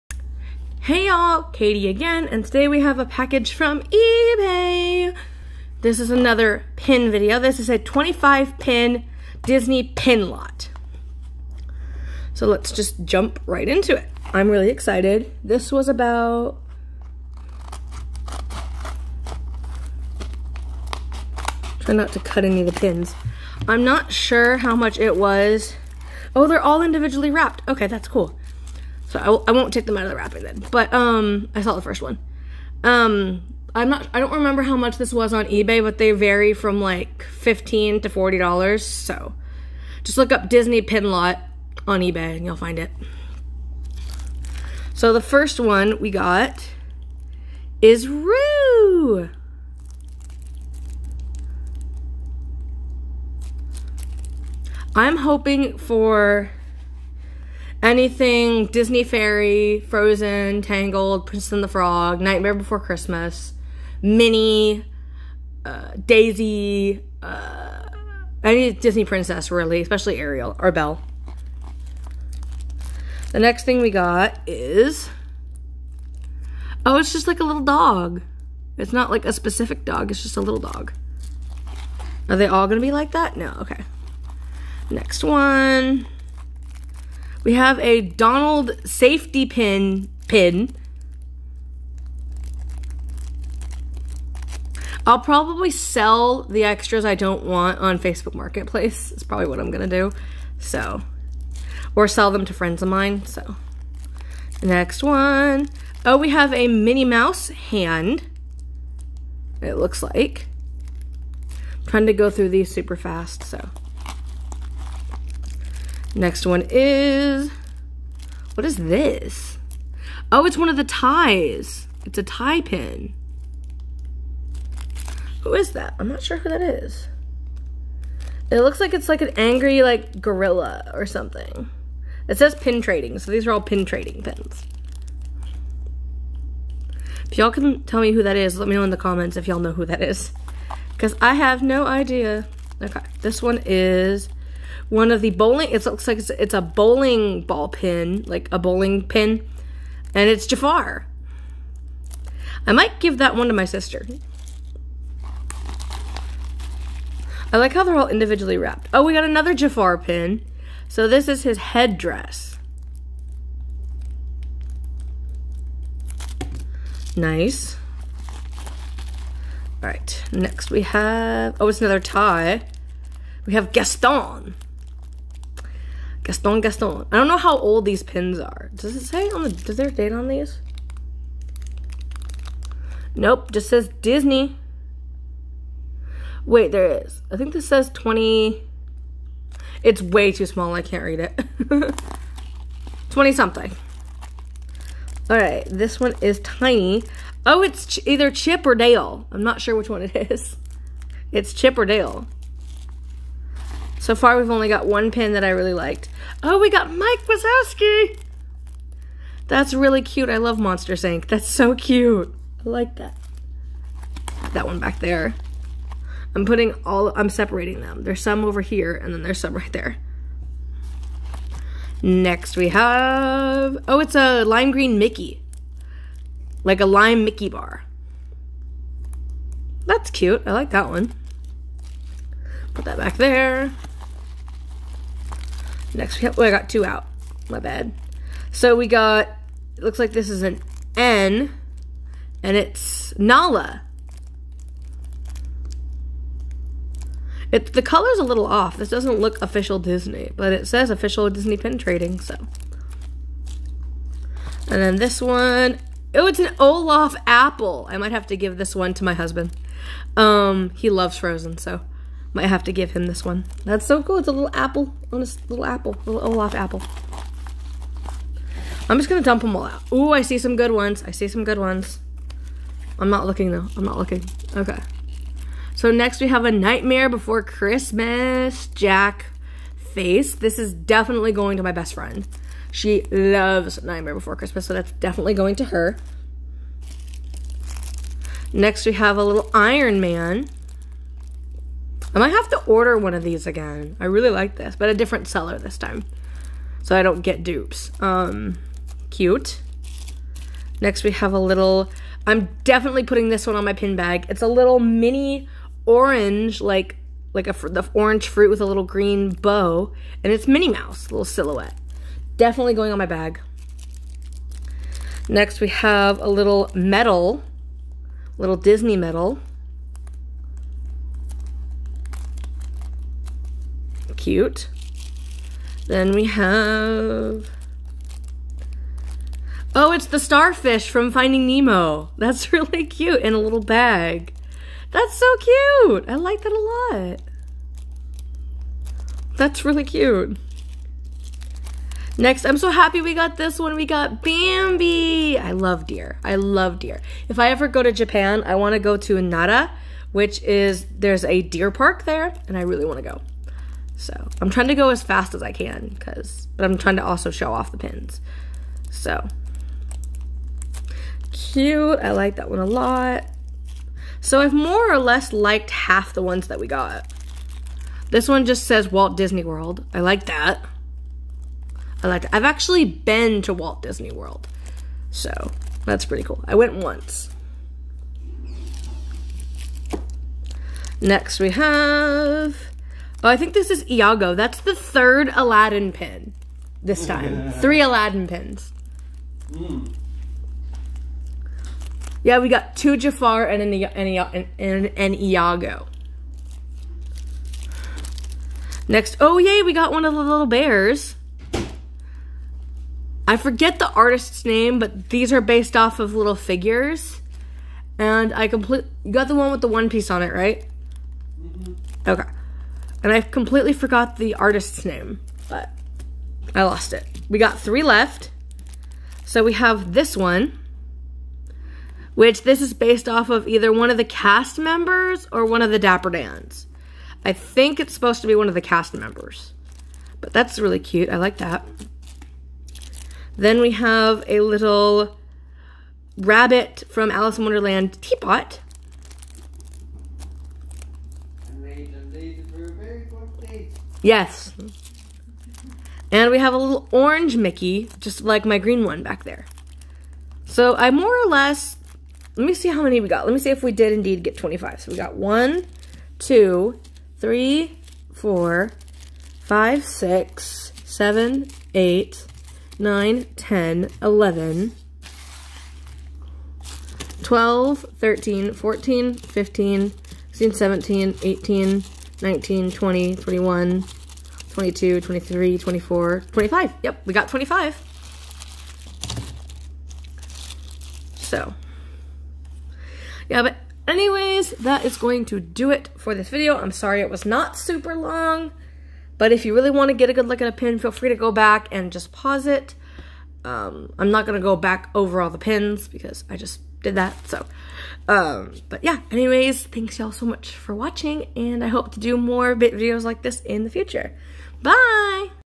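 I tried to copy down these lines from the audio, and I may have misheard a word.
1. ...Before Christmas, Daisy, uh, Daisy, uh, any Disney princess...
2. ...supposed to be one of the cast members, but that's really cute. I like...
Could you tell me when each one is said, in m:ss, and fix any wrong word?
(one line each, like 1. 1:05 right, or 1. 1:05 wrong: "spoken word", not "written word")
1. 1:02 wrong: "Minnie", not "Daisy"
2. 7:07 right.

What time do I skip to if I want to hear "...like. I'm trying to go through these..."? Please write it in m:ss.
1:50.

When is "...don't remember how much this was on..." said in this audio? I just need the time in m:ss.
0:34.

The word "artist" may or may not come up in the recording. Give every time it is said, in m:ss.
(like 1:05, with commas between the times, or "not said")
6:43, 6:54.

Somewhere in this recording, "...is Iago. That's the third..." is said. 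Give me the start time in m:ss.
6:23.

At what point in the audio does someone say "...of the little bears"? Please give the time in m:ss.
6:40.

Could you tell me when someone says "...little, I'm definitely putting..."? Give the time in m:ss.
5:01.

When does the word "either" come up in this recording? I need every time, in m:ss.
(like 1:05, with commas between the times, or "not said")
3:18, 7:03.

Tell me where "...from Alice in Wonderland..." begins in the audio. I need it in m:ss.
7:16.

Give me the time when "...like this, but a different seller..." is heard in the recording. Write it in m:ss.
4:54.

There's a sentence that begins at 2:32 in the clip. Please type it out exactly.
I might give that one to my sister.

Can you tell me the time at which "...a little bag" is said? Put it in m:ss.
5:33.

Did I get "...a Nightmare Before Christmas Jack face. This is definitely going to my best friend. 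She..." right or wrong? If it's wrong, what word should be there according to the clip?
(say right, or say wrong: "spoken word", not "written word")
right.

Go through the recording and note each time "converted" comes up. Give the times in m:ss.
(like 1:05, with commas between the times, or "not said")
not said.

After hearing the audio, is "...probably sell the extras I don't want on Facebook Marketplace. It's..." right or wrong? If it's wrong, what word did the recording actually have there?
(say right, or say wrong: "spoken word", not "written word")
right.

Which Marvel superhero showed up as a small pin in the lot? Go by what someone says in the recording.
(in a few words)
Iron Man.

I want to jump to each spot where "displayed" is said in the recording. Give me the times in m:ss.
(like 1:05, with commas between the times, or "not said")
not said.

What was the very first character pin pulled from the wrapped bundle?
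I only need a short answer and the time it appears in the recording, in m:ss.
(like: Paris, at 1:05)
Roo, at 0:48.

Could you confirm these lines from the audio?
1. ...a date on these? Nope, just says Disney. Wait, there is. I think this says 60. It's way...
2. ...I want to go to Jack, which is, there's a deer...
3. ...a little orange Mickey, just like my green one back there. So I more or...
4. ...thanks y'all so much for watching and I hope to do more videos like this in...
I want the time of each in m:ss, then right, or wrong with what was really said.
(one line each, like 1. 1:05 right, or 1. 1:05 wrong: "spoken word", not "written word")
1. 2:59 wrong: "20", not "60"
2. 5:48 wrong: "Nara", not "Jack"
3. 7:26 right
4. 8:19 right.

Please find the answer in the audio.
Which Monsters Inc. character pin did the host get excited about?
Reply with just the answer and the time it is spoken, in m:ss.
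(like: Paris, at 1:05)
Mike Wazowski, at 3:26.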